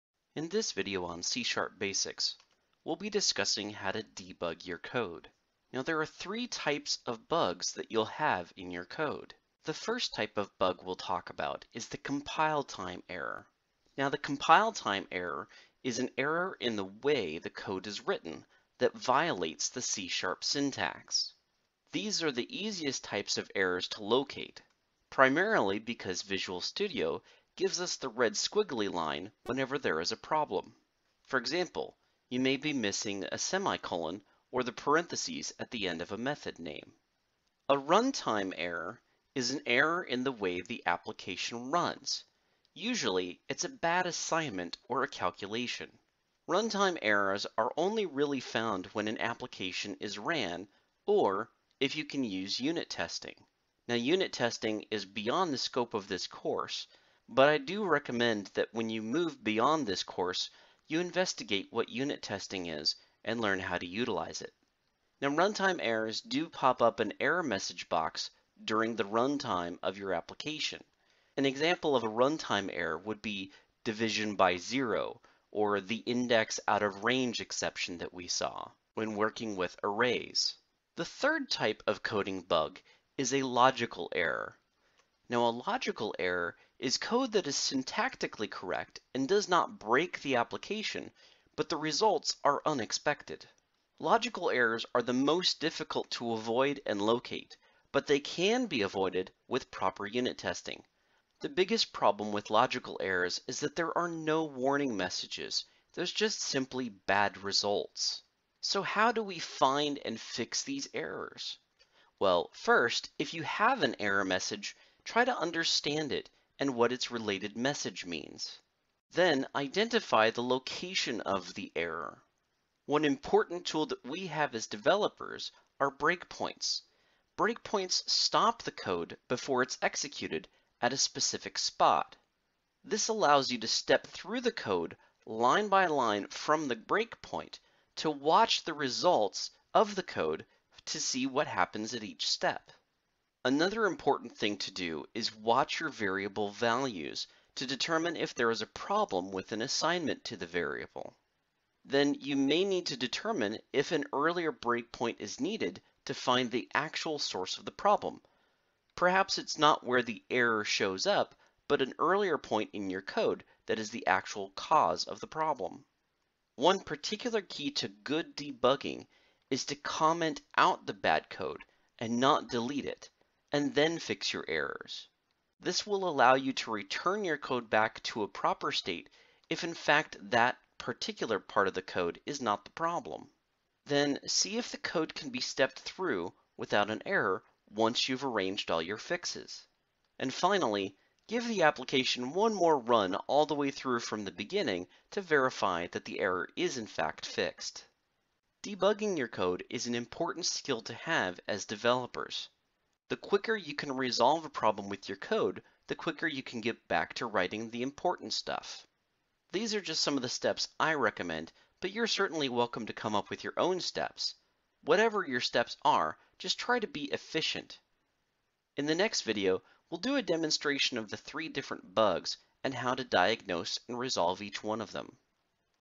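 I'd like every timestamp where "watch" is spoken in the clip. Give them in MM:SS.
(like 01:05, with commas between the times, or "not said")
02:18, 02:25.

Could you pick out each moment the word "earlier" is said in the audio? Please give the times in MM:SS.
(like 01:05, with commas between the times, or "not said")
02:34, 02:41.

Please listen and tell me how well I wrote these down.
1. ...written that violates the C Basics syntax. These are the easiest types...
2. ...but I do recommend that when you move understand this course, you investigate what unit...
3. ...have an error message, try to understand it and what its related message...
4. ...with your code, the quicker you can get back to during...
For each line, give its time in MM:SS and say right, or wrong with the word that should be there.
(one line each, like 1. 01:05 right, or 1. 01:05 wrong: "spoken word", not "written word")
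1. 00:18 wrong: "Sharp", not "Basics"
2. 00:57 wrong: "beyond", not "understand"
3. 01:53 right
4. 03:24 wrong: "writing", not "during".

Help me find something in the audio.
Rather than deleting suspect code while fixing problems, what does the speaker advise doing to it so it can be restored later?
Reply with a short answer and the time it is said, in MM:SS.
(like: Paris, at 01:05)
comment out, at 02:49.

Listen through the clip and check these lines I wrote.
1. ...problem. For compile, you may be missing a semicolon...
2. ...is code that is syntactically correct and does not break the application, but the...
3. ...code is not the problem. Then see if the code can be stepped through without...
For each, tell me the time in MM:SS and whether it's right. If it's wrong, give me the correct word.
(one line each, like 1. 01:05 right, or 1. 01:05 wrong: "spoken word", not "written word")
1. 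00:30 wrong: "example", not "compile"
2. 01:26 right
3. 03:01 right.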